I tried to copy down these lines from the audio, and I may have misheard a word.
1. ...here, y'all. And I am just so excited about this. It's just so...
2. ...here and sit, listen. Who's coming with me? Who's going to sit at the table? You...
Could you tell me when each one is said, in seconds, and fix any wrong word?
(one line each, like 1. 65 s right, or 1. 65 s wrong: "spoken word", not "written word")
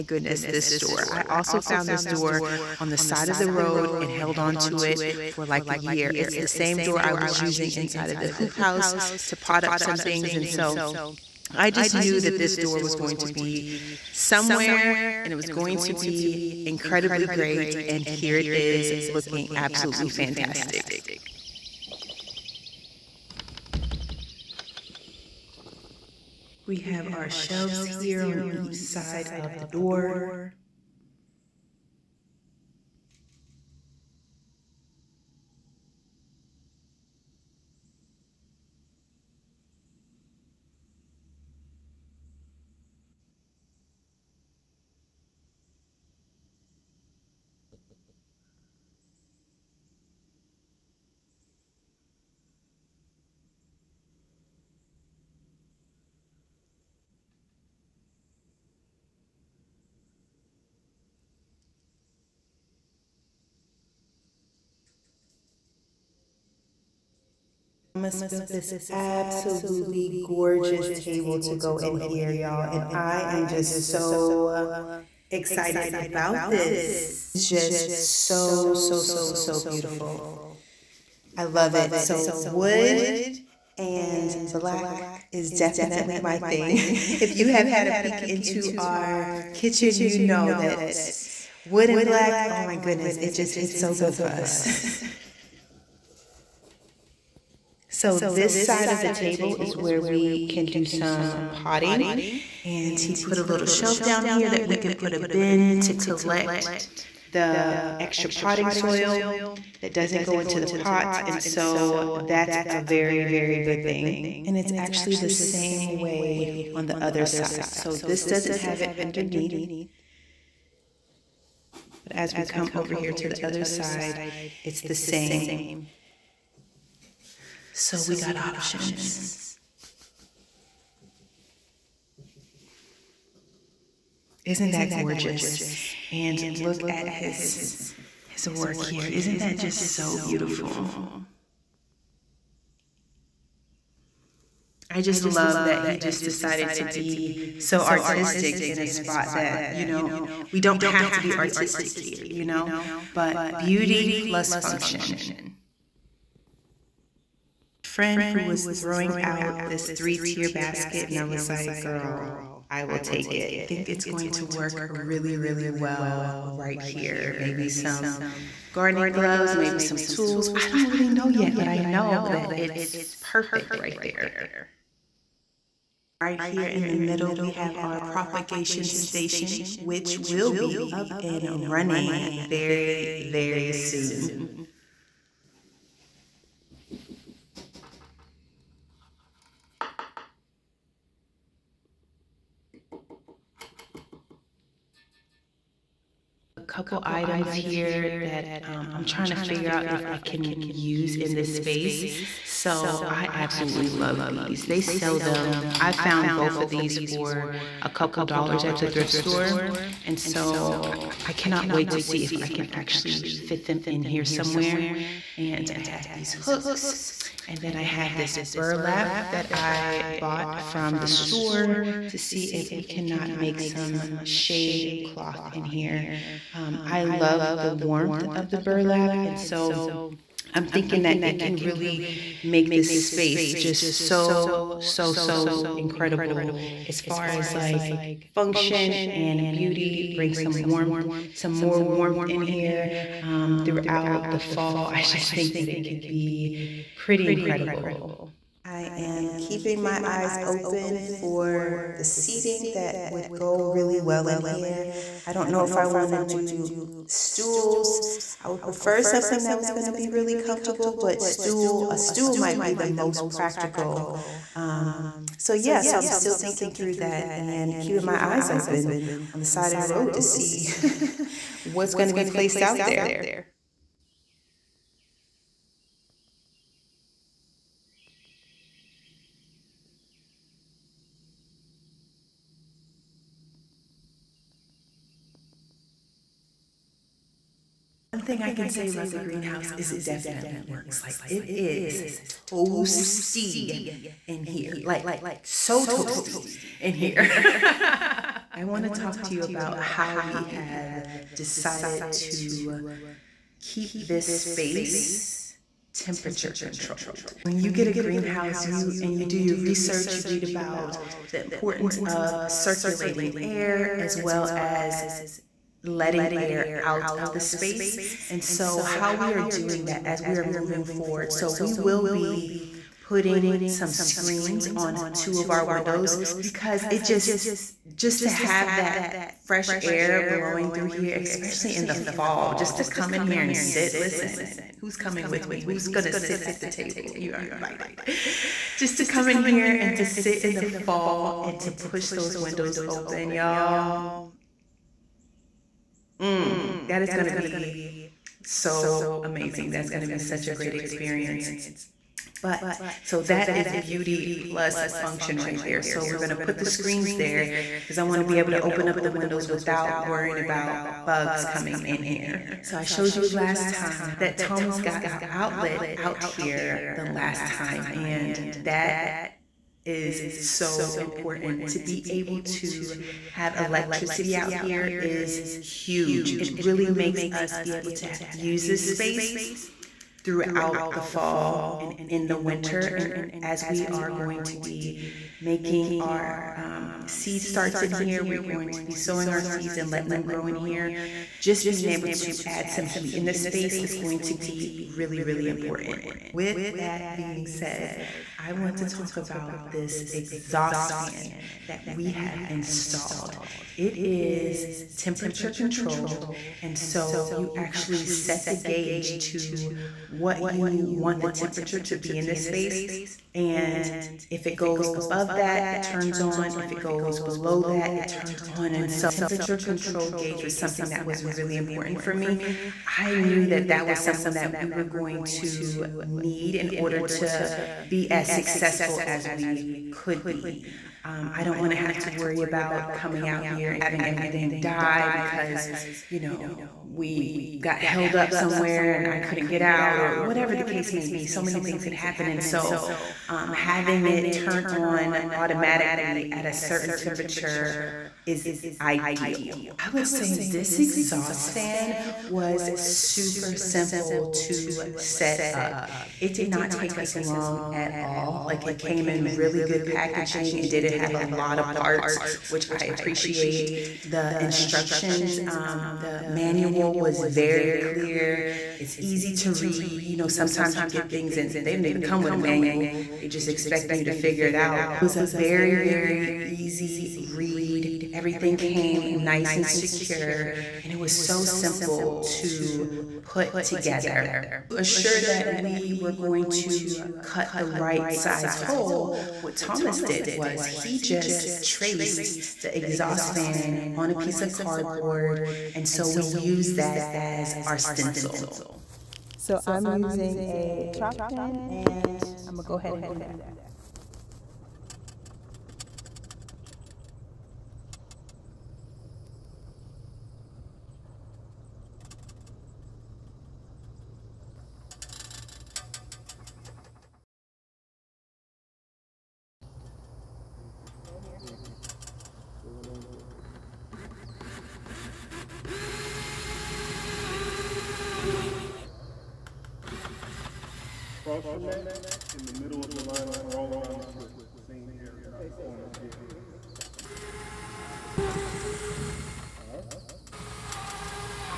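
1. 71 s right
2. 333 s right.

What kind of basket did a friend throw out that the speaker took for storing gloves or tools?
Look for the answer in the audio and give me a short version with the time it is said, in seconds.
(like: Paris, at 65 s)
Three tier basket, at 159 s.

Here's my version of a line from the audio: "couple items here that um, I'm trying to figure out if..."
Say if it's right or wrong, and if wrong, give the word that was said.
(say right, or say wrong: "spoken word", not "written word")
right.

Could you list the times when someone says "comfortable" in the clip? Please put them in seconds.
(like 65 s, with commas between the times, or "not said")
260 s.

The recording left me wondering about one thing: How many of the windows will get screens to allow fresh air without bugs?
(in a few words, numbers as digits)
2.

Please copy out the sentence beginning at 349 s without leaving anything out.
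That's going to be such a great experience.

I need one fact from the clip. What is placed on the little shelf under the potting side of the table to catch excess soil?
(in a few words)
A bin.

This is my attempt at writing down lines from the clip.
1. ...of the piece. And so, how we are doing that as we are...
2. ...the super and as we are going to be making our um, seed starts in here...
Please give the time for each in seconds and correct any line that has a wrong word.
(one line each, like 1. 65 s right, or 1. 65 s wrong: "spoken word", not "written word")
1. 317 s wrong: "space", not "piece"
2. 382 s wrong: "winter", not "super".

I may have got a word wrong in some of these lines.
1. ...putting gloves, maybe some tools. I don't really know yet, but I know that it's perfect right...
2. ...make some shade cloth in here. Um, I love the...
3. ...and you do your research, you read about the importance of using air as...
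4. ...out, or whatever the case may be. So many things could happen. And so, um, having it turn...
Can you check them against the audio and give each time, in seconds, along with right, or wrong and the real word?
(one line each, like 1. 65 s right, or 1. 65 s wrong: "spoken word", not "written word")
1. 168 s wrong: "gardening", not "putting"
2. 223 s right
3. 308 s wrong: "circulating", not "using"
4. 439 s right.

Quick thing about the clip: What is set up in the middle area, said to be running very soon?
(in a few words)
Propagation station.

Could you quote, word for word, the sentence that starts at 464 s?
The instructions, um, the manual was very clear.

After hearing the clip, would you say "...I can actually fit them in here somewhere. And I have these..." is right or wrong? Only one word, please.
right.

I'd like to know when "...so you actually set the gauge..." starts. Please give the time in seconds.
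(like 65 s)
406 s.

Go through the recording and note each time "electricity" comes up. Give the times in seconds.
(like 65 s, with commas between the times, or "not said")
373 s.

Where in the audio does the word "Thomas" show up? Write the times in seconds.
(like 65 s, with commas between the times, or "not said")
364 s, 489 s.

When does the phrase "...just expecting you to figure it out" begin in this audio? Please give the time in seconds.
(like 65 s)
473 s.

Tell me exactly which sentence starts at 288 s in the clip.
thing I can say about the greenhouse is it definitely works.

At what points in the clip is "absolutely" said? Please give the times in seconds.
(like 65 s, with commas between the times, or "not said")
19 s, 68 s, 203 s.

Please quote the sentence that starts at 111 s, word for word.
And so that's a very, very good thing.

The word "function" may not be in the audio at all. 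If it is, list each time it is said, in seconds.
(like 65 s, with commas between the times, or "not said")
154 s, 238 s, 354 s.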